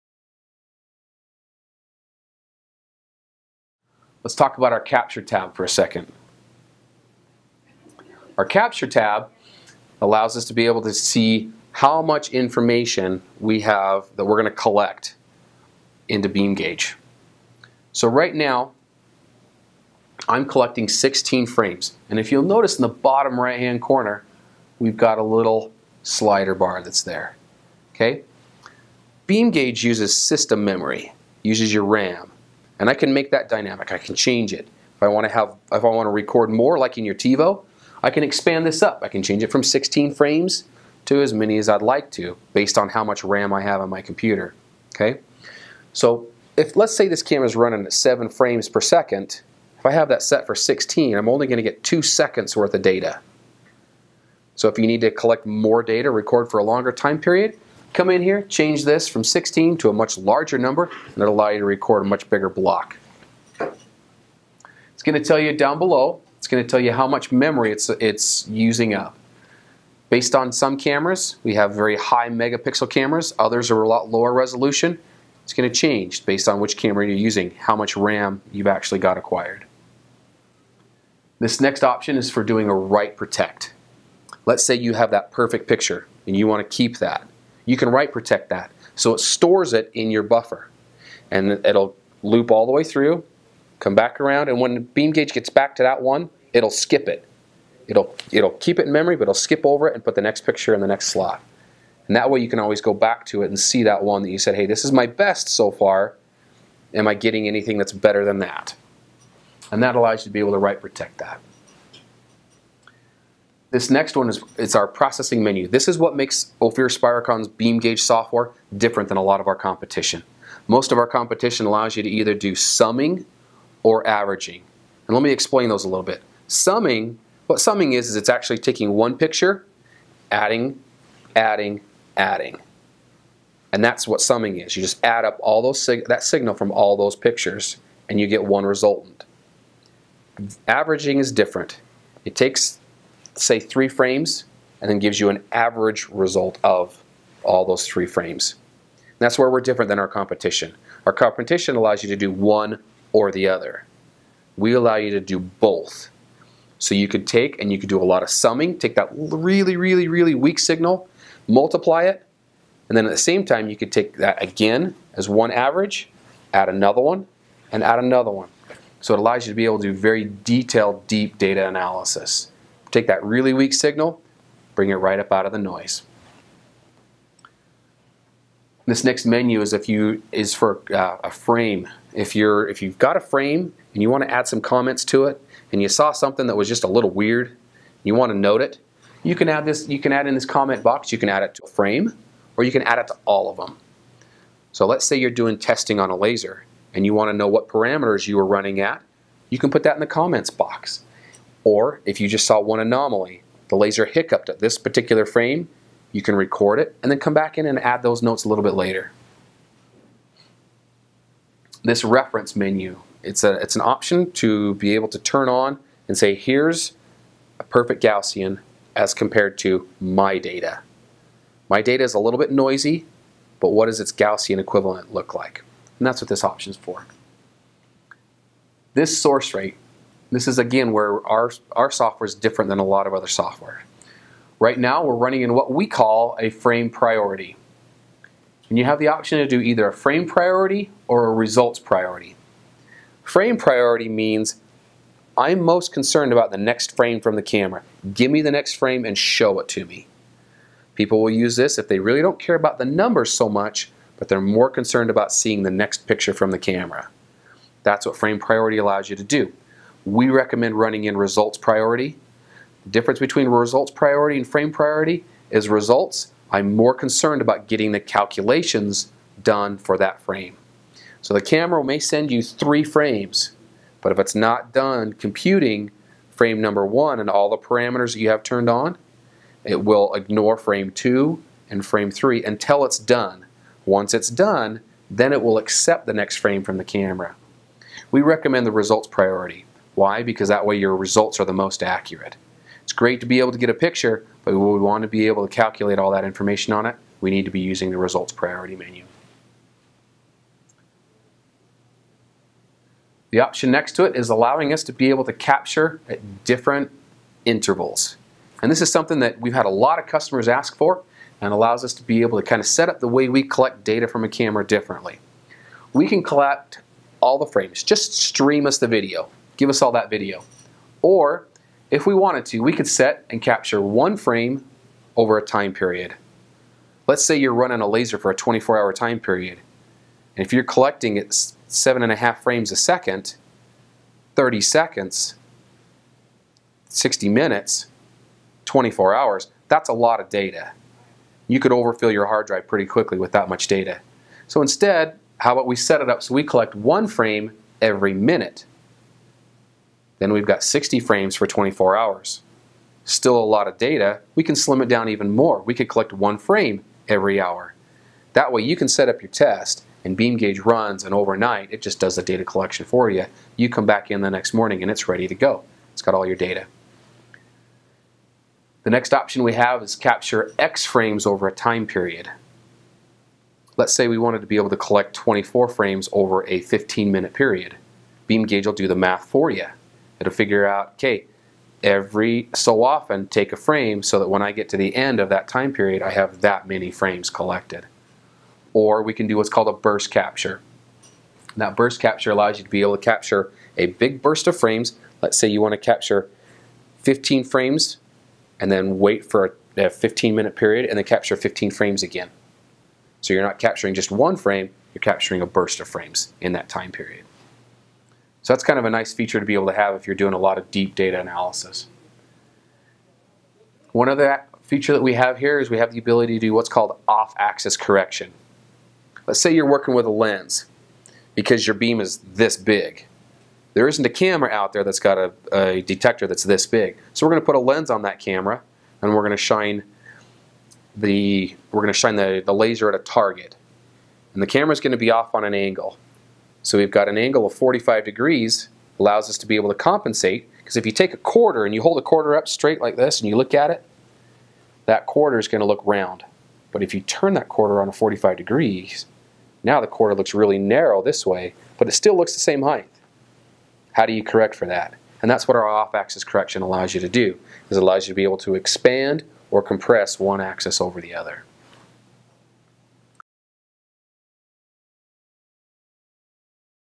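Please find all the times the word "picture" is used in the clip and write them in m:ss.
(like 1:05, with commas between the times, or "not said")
1:25, 1:40, 2:09, 2:17, 4:16, 4:53.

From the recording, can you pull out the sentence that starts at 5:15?
We can collect all the frames, just stream us the video give us all that video.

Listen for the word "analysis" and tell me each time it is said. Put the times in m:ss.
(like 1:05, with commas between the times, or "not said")
2:51, 6:51.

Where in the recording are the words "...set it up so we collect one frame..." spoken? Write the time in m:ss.
5:45.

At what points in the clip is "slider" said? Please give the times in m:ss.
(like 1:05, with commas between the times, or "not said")
0:26.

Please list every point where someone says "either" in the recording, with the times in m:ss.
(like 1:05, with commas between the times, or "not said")
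2:02, 3:59.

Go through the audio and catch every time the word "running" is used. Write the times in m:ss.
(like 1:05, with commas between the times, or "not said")
0:47, 3:18, 3:55, 4:20, 5:27.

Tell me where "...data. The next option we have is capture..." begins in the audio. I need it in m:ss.
6:06.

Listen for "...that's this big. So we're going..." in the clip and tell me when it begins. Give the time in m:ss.
7:06.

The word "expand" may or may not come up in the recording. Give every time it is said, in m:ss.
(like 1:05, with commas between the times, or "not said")
0:38, 7:38.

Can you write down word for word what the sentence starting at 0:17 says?
So right now, I'm collecting 16 frames.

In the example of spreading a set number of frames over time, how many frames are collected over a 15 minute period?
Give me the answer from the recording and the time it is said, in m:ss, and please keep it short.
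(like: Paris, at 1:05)
24, at 6:15.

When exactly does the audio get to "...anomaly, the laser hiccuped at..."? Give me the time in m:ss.
3:22.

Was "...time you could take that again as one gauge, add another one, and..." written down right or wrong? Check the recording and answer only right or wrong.
wrong.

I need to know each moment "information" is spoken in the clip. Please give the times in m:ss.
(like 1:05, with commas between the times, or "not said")
0:12, 4:56.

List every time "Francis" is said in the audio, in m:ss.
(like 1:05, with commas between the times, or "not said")
not said.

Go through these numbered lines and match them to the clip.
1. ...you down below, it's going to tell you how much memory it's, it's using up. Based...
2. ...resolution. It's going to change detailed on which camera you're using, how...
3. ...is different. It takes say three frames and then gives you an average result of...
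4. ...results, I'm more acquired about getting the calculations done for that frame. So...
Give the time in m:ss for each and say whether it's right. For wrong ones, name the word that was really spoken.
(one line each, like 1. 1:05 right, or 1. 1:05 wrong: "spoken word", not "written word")
1. 1:05 right
2. 1:14 wrong: "based", not "detailed"
3. 2:21 right
4. 4:25 wrong: "concerned", not "acquired".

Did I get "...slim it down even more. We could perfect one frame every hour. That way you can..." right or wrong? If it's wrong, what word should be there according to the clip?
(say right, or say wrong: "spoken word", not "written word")
wrong: "collect", not "perfect".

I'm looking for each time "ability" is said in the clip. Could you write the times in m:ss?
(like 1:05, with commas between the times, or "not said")
6:55.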